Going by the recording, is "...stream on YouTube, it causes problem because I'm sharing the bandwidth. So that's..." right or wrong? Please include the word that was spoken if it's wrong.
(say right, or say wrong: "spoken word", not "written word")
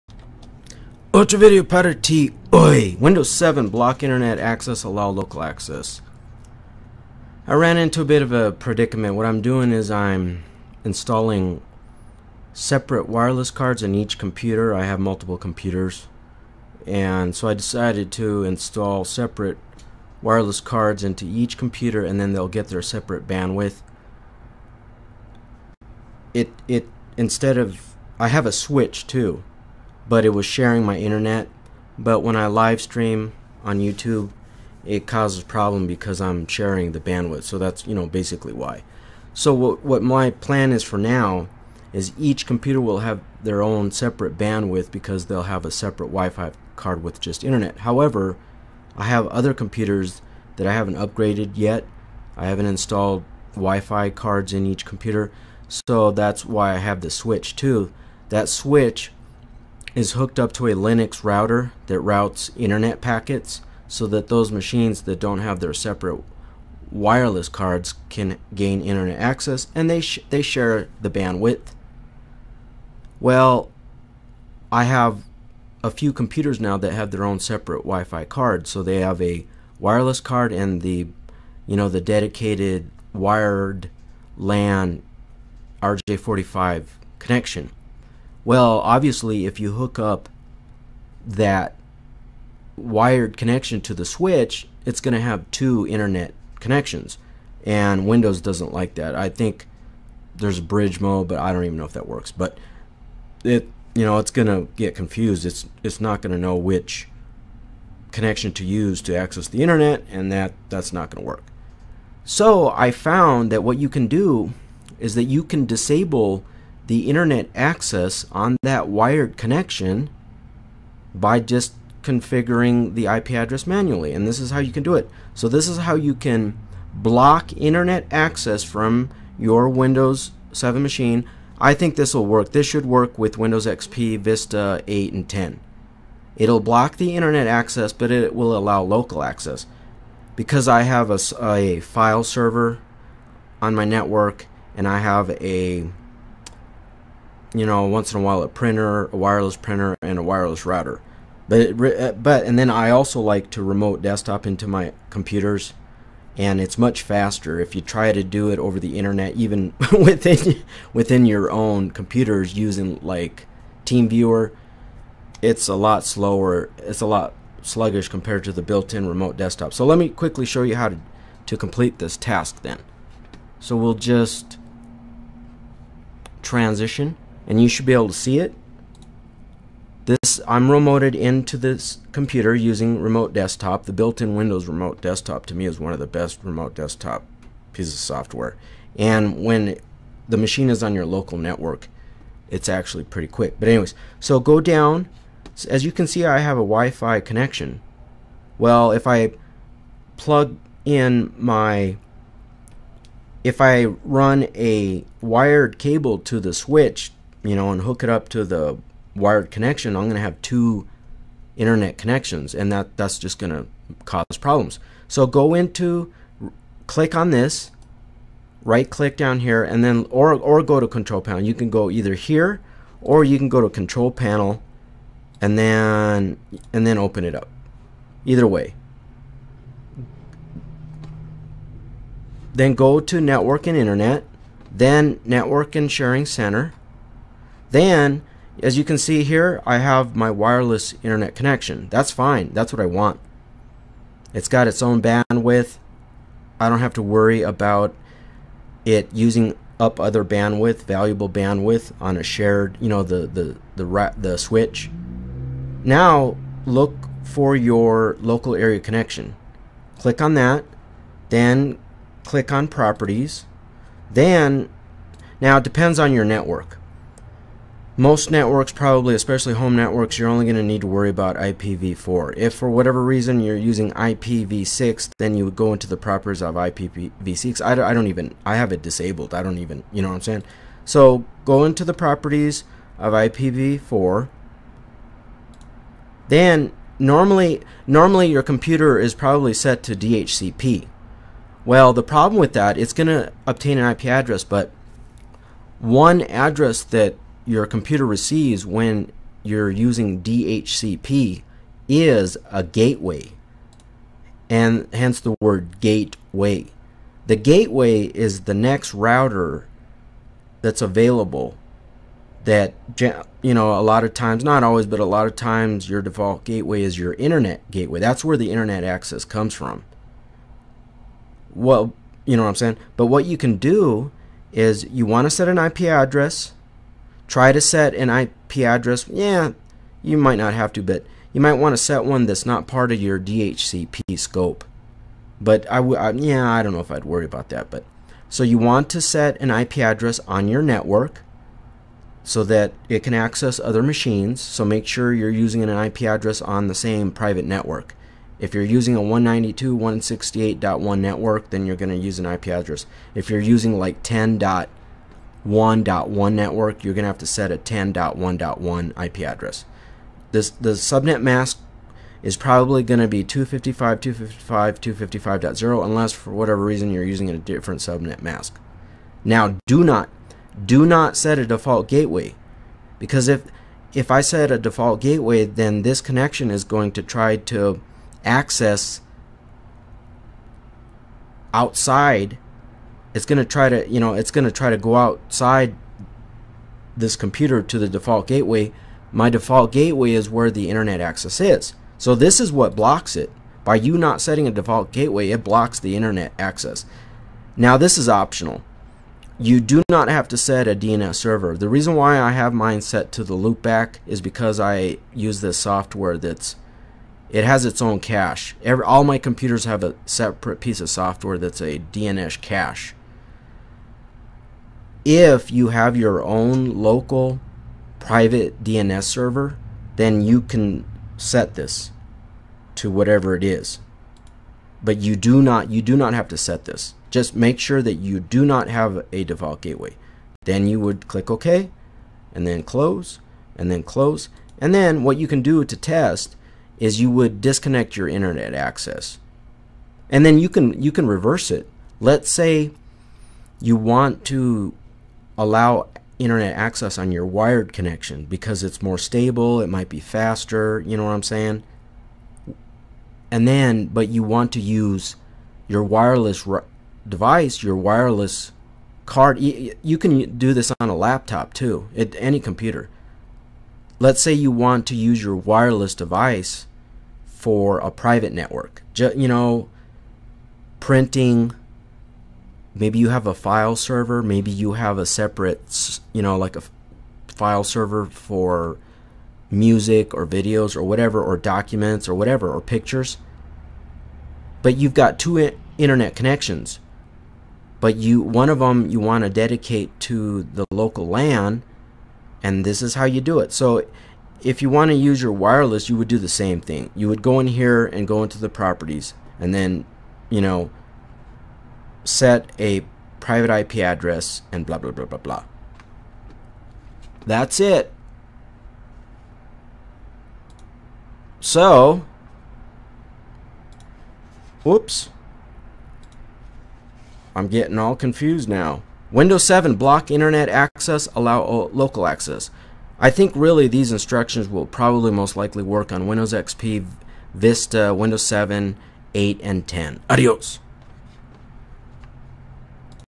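right.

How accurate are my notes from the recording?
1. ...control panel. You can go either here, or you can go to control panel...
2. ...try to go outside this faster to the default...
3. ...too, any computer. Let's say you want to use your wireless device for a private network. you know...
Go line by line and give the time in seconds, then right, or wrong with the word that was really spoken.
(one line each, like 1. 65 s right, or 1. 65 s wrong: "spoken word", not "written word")
1. 220 s right
2. 384 s wrong: "computer", not "faster"
3. 461 s right.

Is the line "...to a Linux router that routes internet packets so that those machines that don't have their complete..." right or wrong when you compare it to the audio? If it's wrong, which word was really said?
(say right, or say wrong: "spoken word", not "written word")
wrong: "separate", not "complete".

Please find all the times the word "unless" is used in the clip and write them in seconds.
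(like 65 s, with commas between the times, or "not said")
365 s.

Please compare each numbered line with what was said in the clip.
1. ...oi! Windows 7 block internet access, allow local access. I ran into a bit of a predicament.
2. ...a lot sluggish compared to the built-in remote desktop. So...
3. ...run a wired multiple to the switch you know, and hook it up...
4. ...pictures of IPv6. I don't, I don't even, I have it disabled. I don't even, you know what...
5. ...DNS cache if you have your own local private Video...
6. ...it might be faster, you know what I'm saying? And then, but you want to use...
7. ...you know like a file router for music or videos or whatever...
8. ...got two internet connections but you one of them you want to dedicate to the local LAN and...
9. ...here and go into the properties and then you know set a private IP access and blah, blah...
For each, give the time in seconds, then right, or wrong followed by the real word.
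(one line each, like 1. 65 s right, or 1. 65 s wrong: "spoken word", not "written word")
1. 2 s right
2. 167 s right
3. 203 s wrong: "cable", not "multiple"
4. 275 s wrong: "properties", not "pictures"
5. 411 s wrong: "DNS", not "Video"
6. 449 s right
7. 476 s wrong: "server", not "router"
8. 484 s right
9. 497 s wrong: "address", not "access".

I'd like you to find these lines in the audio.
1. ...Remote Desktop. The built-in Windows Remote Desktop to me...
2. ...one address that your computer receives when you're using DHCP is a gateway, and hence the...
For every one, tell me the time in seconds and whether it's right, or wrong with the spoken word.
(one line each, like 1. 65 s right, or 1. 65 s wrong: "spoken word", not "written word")
1. 183 s right
2. 295 s right.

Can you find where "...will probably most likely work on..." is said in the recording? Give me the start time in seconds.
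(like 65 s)
524 s.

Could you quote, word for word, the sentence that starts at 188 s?
And when the machine is on your local network, it's actually pretty quick.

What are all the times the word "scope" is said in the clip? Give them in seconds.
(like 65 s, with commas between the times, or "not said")
334 s.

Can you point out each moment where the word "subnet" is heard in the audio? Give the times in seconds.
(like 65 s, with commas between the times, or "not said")
360 s, 367 s.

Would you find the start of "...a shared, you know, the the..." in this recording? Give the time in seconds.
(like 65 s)
252 s.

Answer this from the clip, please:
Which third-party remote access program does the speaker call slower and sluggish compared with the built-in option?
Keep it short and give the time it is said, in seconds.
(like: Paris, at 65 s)
TeamViewer, at 163 s.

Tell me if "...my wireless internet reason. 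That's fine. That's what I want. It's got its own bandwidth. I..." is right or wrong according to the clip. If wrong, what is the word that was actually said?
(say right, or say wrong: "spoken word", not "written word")
wrong: "connection", not "reason".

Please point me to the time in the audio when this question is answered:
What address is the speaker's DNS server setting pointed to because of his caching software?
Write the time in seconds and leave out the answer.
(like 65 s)
403 s.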